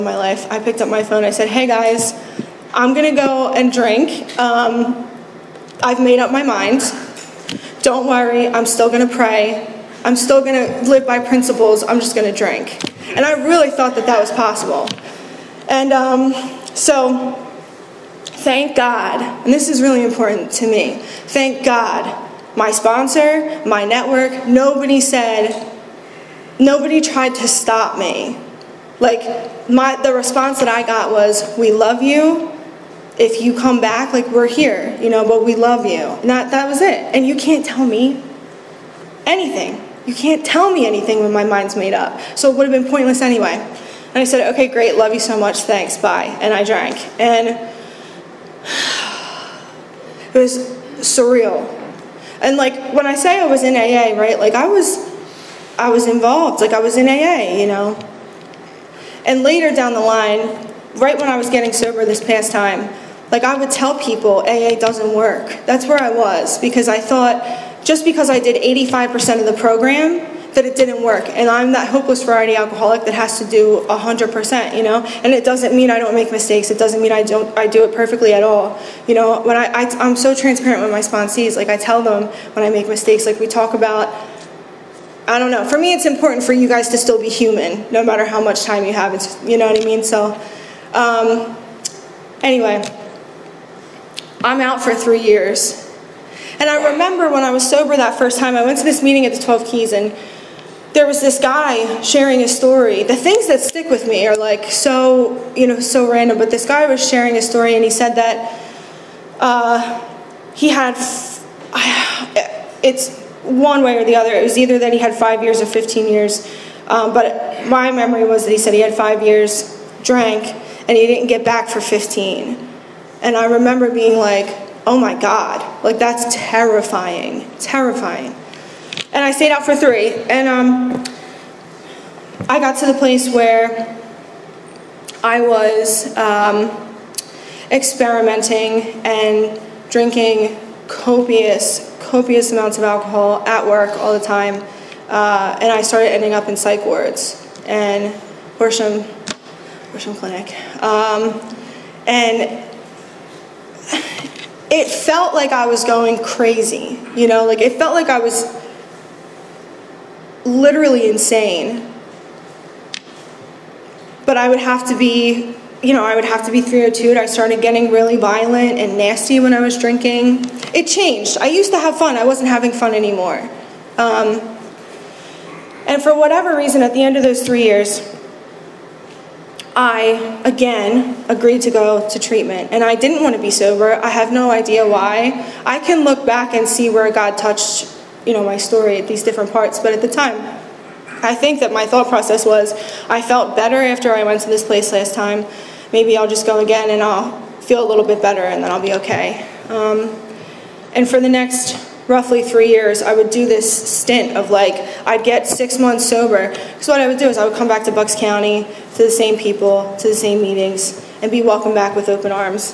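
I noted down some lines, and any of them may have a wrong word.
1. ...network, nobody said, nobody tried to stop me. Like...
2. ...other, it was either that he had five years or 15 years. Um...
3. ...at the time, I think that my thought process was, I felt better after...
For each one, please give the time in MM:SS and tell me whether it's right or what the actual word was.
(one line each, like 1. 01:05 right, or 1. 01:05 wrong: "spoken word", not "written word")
1. 00:23 right
2. 01:54 right
3. 03:09 right.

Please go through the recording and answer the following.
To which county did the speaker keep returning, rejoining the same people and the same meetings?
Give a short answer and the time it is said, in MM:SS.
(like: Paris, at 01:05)
Bucks County, at 03:27.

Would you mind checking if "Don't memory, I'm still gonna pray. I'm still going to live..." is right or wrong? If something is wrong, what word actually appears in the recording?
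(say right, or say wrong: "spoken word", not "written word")
wrong: "worry", not "memory".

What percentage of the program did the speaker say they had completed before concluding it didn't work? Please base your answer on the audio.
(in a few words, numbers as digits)
85%.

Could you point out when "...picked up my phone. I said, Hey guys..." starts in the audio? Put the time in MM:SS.
00:00.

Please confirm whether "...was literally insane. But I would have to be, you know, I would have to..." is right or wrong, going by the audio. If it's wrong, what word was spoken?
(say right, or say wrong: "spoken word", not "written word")
right.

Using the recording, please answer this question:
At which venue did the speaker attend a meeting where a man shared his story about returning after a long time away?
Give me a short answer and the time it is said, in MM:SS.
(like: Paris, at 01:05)
12 Keys, at 01:39.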